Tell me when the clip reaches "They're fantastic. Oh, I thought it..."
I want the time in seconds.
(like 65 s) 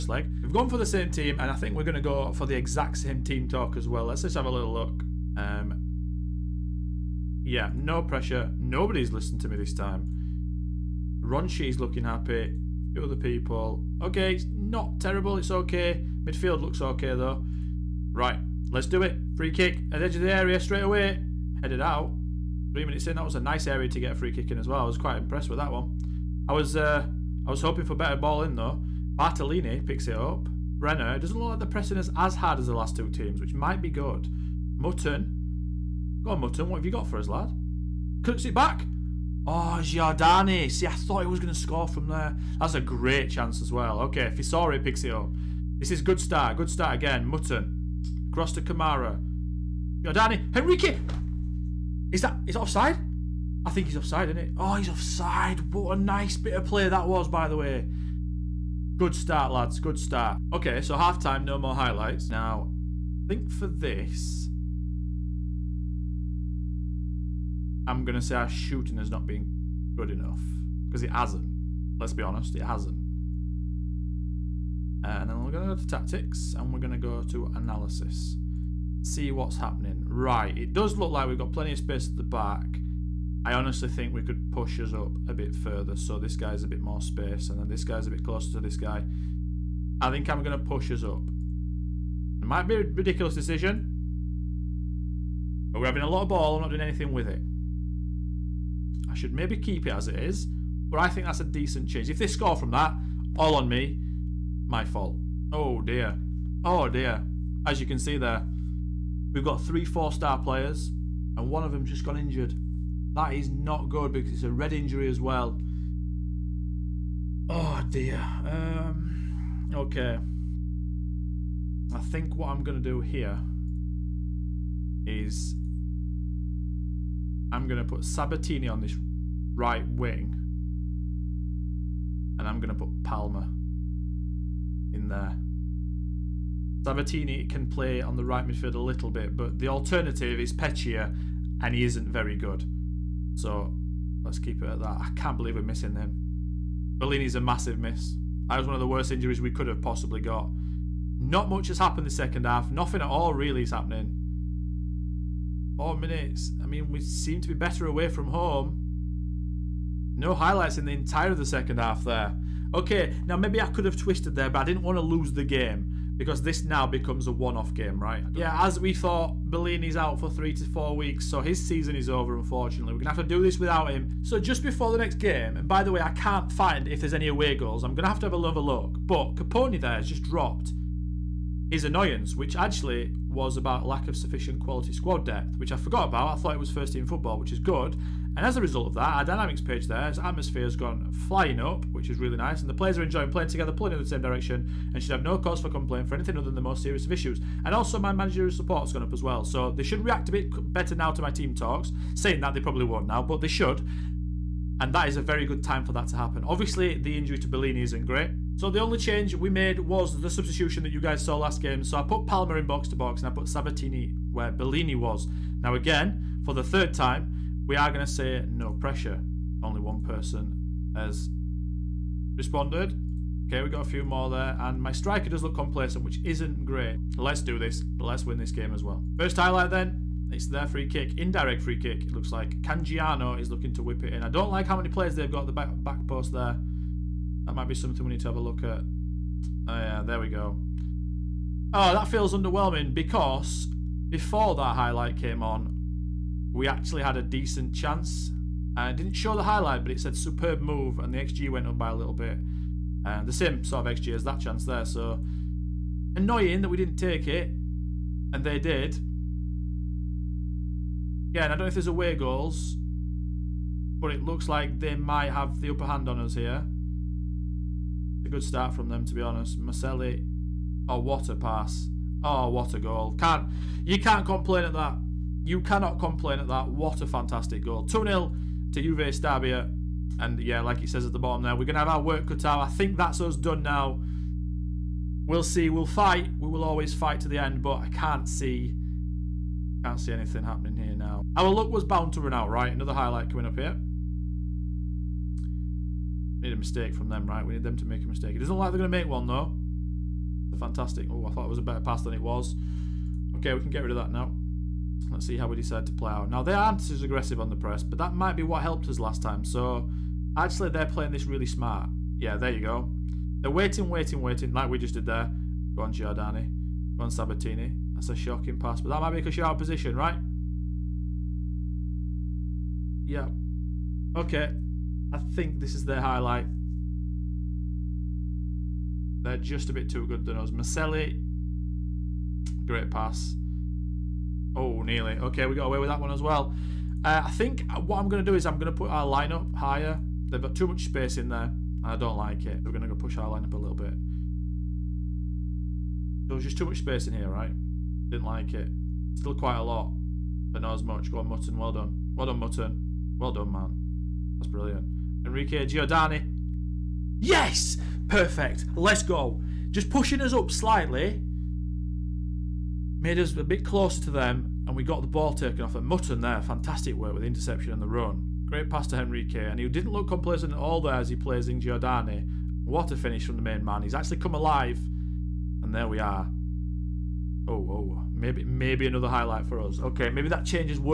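300 s.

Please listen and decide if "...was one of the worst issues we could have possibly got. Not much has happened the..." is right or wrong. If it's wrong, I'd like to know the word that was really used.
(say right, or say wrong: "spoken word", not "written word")
wrong: "injuries", not "issues".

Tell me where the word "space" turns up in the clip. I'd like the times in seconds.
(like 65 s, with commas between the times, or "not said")
81 s, 87 s, 340 s, 346 s.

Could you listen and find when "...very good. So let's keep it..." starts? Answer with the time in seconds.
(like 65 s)
142 s.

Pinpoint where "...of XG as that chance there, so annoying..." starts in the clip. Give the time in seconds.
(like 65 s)
253 s.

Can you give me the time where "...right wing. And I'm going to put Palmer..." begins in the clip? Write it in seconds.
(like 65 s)
129 s.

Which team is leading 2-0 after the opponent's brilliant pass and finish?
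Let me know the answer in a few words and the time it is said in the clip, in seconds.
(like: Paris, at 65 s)
Juve Stabia, at 278 s.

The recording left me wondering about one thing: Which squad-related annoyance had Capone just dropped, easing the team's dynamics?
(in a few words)
Lack of sufficient quality squad depth.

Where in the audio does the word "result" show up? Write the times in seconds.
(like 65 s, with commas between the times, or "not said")
188 s.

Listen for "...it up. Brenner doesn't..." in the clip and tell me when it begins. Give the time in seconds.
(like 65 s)
30 s.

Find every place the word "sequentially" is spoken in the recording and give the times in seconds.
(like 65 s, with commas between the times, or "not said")
not said.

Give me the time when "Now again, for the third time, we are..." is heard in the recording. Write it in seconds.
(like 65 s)
215 s.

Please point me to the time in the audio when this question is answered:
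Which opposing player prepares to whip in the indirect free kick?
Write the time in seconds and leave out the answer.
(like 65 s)
232 s.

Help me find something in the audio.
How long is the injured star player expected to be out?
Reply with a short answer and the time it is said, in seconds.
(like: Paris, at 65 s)
3 to 4 weeks, at 170 s.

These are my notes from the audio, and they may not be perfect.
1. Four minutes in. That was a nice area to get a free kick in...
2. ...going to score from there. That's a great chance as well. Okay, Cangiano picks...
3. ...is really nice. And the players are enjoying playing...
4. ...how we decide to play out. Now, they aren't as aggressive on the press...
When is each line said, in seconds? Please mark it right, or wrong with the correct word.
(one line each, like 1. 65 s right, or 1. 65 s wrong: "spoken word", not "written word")
1. 22 s wrong: "Three", not "Four"
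2. 41 s wrong: "Fisori", not "Cangiano"
3. 192 s right
4. 305 s right.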